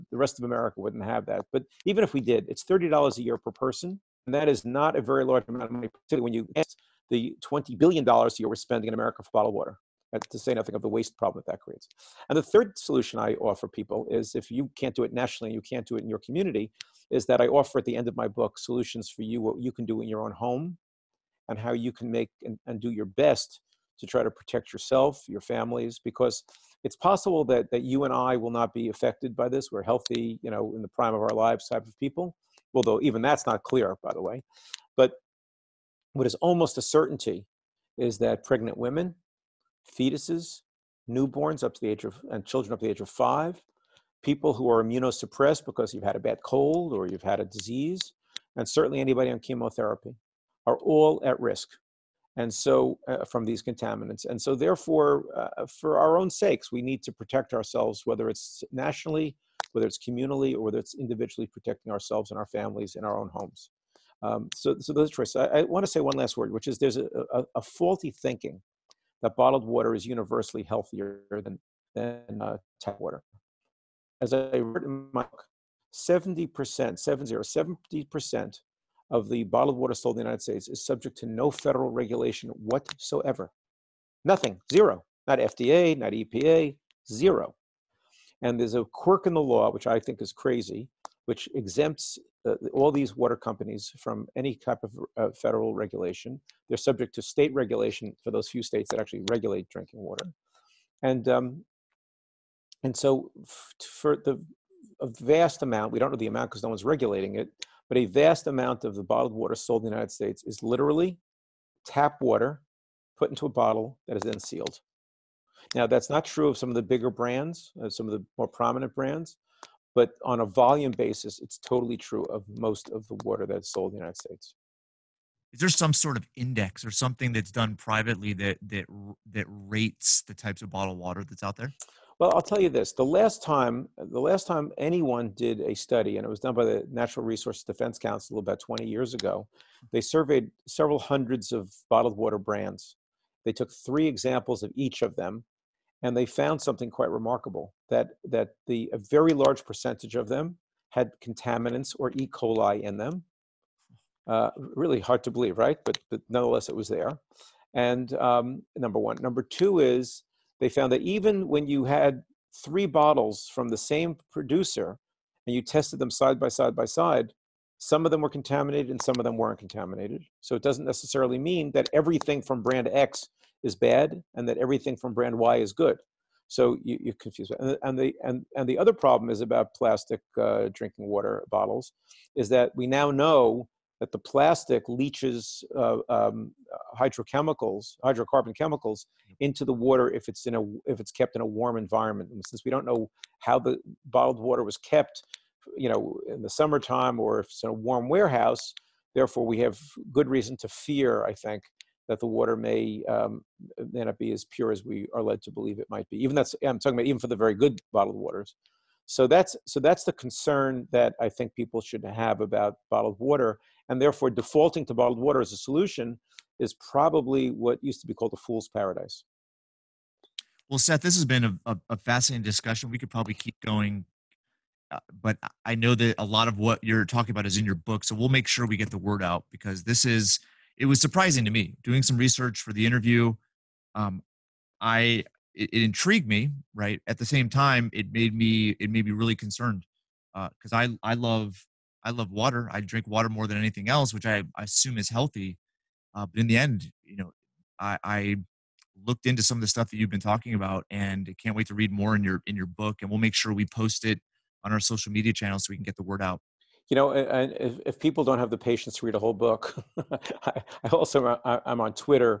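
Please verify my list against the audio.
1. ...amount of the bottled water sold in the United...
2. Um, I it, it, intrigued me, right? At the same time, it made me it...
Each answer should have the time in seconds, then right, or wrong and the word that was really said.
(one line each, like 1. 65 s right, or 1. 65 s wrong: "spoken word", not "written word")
1. 108 s right
2. 233 s right.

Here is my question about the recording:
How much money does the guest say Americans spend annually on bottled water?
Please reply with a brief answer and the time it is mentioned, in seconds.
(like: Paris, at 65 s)
$20 billion, at 7 s.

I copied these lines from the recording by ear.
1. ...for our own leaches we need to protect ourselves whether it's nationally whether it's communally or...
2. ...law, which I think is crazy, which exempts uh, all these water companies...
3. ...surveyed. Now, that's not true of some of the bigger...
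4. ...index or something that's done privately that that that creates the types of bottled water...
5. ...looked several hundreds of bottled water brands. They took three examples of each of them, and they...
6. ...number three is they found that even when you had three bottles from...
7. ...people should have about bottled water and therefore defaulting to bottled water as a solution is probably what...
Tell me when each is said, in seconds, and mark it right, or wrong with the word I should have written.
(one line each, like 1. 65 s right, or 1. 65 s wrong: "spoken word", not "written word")
1. 55 s wrong: "sakes", not "leaches"
2. 89 s right
3. 114 s wrong: "sealed", not "surveyed"
4. 126 s wrong: "rates", not "creates"
5. 140 s wrong: "surveyed", not "looked"
6. 159 s wrong: "two", not "three"
7. 211 s right.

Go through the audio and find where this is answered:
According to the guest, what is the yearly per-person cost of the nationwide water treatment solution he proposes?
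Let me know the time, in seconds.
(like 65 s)
2 s.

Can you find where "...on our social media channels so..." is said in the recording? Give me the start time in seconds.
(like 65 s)
254 s.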